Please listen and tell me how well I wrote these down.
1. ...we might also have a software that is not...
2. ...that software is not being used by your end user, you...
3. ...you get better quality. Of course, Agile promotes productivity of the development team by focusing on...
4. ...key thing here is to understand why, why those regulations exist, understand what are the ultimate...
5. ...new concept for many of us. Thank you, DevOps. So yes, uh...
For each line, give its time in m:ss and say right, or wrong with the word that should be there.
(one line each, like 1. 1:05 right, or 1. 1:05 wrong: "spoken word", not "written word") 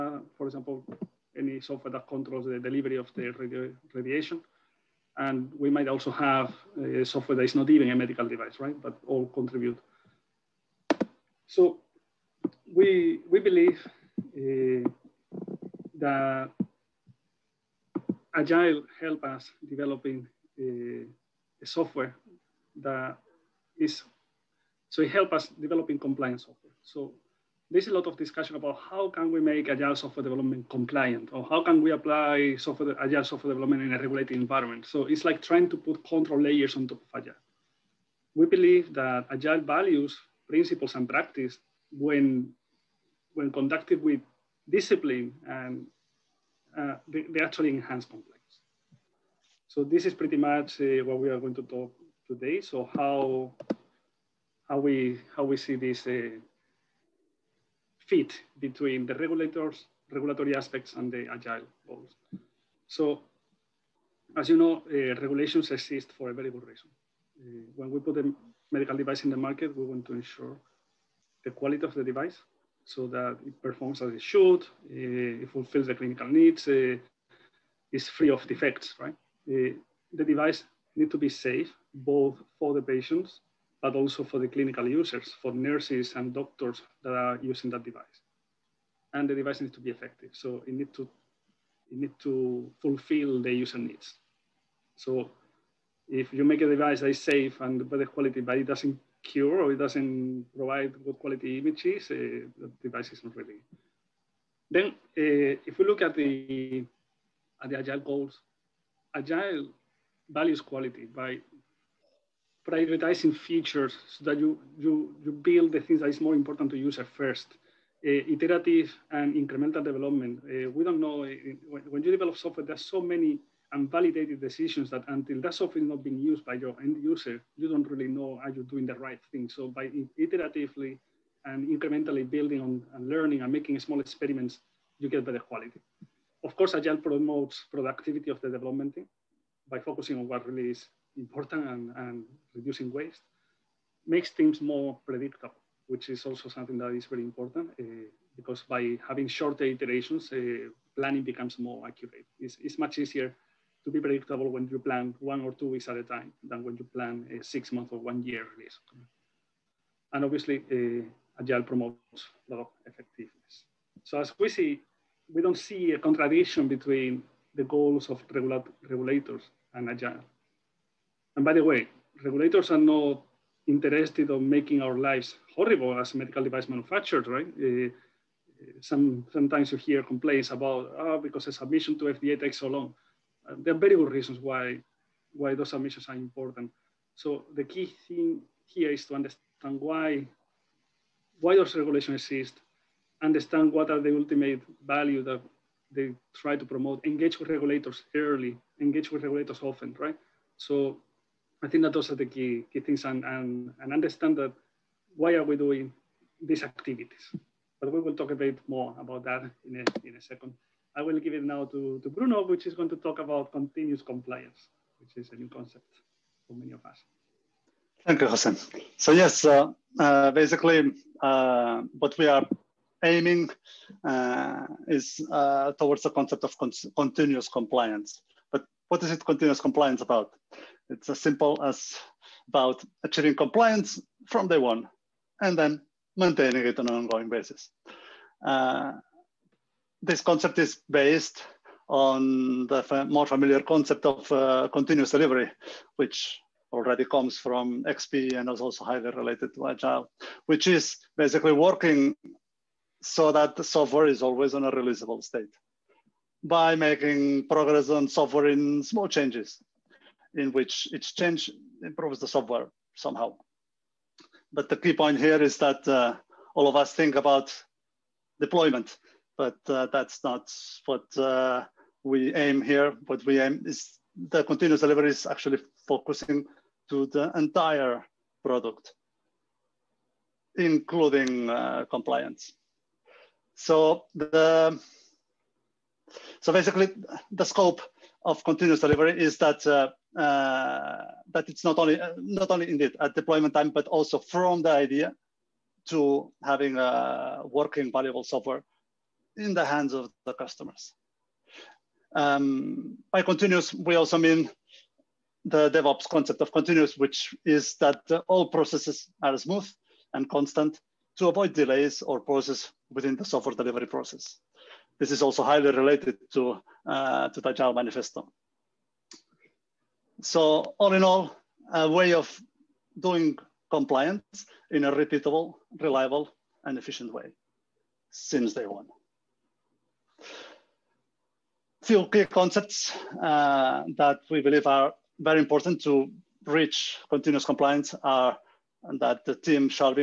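1. 0:05 right
2. 2:05 right
3. 2:14 right
4. 3:07 right
5. 3:35 wrong: "Jose", not "DevOps".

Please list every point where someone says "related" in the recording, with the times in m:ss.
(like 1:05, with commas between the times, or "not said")
4:09, 5:15.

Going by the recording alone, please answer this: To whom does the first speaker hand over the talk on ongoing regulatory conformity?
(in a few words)
Bruno.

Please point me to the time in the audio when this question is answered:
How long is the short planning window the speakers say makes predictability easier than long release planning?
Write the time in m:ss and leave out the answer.
2:35.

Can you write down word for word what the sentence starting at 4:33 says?
What we aim is the continuous delivery is actually focusing to the entire product, including uh, compliance.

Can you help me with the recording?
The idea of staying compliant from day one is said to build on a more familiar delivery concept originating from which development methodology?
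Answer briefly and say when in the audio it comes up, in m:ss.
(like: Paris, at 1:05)
XP, at 4:07.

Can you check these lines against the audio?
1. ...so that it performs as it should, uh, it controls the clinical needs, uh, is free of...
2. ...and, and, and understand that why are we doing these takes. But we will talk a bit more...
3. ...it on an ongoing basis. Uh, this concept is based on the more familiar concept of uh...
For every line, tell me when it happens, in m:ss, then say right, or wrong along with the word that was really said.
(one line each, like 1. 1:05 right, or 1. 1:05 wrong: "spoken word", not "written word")
1. 1:12 wrong: "fulfills", not "controls"
2. 3:23 wrong: "activities", not "takes"
3. 3:56 right.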